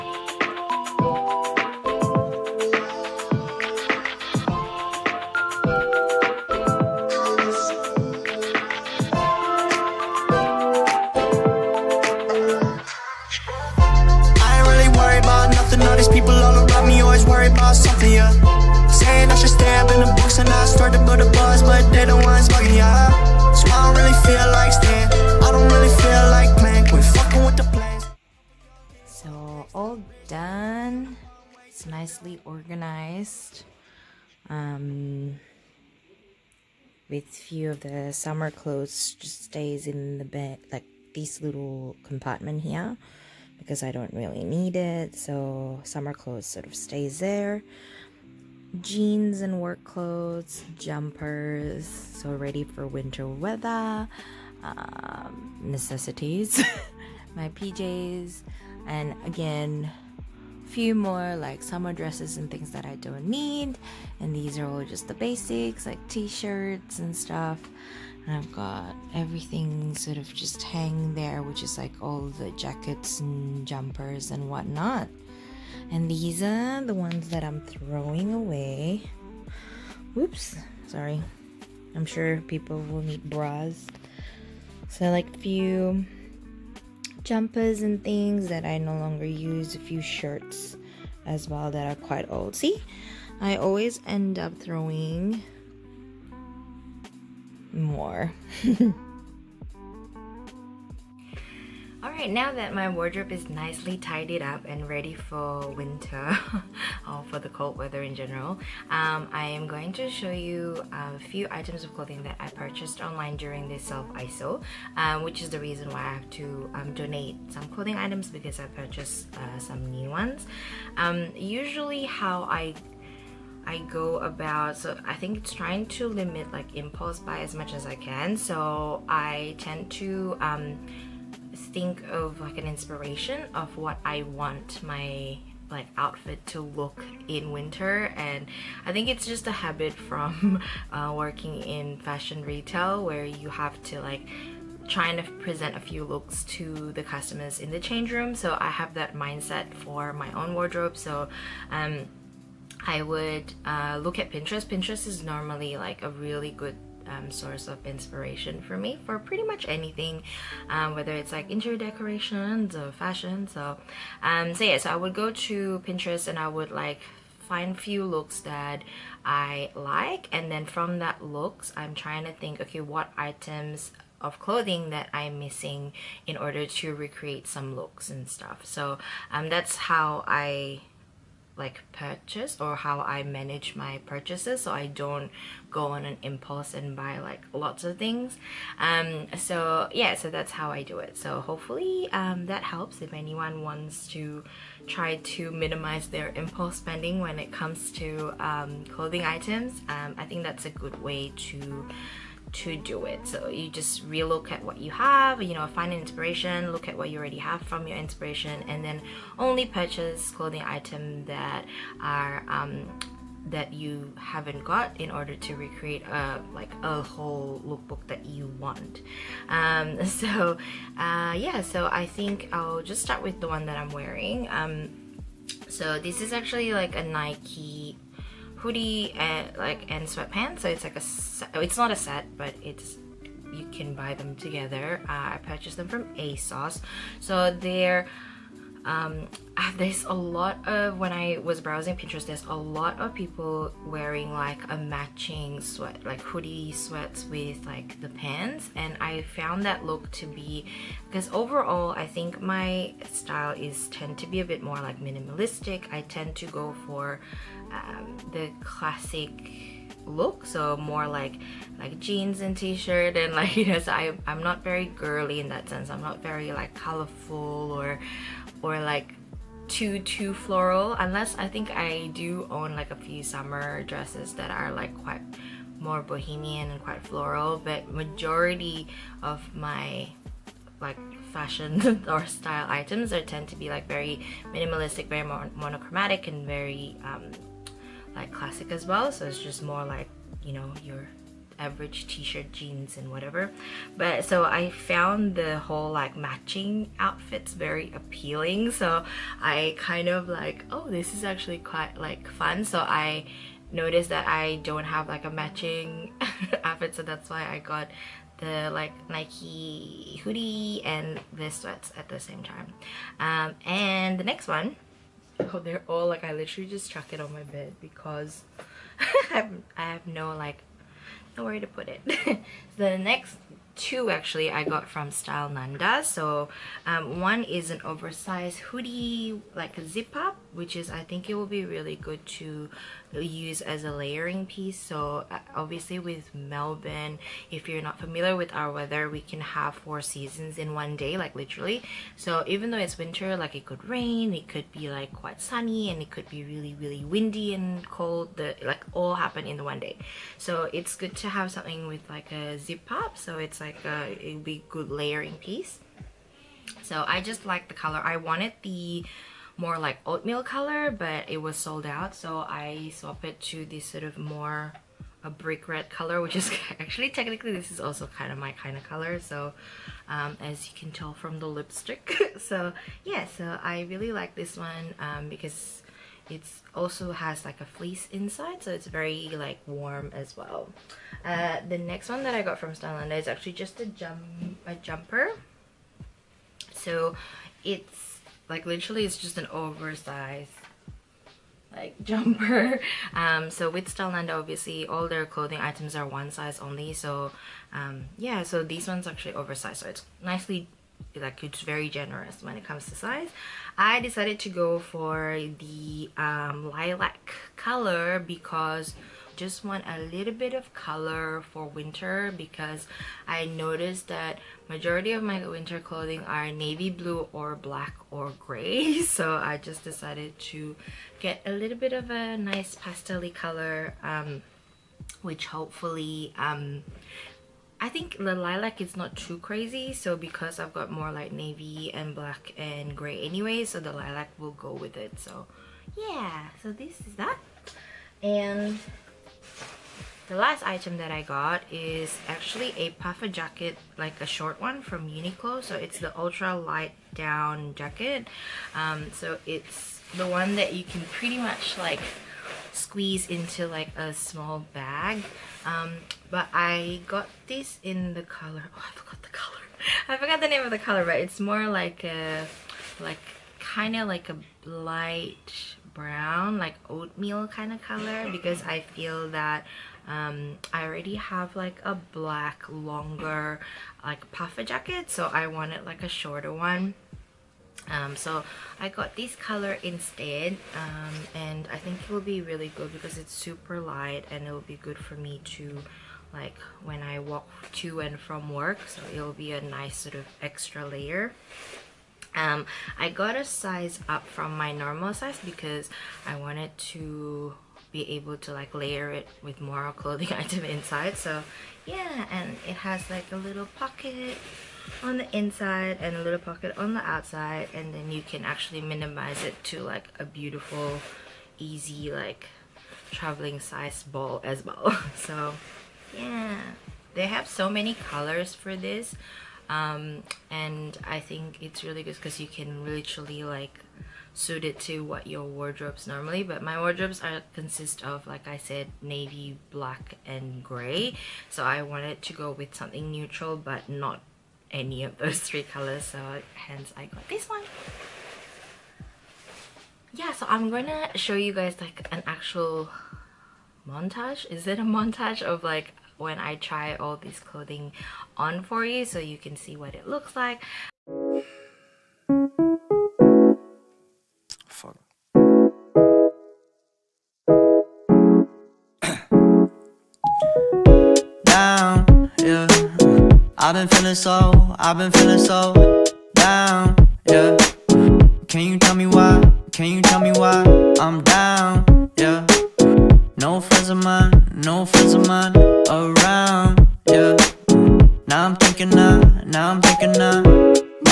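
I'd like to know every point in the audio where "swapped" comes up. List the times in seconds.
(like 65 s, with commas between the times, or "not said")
362 s.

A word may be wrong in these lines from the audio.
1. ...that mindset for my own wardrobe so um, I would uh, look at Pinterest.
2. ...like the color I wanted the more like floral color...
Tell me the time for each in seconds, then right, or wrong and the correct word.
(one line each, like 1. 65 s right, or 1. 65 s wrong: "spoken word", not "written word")
1. 148 s right
2. 357 s wrong: "oatmeal", not "floral".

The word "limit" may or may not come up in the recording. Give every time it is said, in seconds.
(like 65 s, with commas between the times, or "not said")
126 s.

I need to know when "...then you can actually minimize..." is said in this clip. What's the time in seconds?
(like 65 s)
507 s.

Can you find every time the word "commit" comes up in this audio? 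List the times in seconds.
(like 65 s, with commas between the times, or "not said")
not said.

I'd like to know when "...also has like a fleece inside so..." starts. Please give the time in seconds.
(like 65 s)
376 s.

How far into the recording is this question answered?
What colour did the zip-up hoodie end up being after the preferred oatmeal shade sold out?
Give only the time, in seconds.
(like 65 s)
365 s.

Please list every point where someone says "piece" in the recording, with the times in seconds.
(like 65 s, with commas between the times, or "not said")
334 s, 355 s.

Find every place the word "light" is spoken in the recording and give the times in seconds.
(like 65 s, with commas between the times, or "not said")
446 s, 464 s, 483 s.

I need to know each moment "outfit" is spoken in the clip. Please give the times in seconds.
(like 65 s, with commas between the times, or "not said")
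135 s, 296 s, 306 s.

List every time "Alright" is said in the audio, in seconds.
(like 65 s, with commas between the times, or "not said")
102 s.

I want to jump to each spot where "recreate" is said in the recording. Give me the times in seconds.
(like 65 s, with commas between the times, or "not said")
176 s, 215 s.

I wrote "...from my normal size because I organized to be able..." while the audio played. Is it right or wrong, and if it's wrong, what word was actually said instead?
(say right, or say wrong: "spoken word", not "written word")
wrong: "wanted", not "organized".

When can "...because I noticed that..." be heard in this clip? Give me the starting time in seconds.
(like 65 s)
412 s.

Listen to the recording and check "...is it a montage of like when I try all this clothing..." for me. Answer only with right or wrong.
right.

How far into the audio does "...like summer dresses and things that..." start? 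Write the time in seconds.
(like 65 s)
61 s.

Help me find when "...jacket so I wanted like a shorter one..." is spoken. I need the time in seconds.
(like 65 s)
474 s.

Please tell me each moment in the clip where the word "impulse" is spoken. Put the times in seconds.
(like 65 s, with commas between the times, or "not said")
126 s, 186 s, 196 s.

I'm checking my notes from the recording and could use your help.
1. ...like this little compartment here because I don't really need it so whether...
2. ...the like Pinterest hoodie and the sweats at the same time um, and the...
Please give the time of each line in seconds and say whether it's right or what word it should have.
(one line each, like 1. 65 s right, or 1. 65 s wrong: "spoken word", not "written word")
1. 40 s wrong: "summer", not "whether"
2. 308 s wrong: "Nike", not "Pinterest".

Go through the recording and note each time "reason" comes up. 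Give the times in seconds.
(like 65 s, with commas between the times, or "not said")
115 s.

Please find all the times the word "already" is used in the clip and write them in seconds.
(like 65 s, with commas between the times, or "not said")
207 s, 470 s.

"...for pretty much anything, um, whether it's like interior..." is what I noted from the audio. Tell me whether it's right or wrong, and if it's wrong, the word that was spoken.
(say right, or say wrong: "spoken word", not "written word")
right.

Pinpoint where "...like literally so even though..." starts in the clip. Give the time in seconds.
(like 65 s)
341 s.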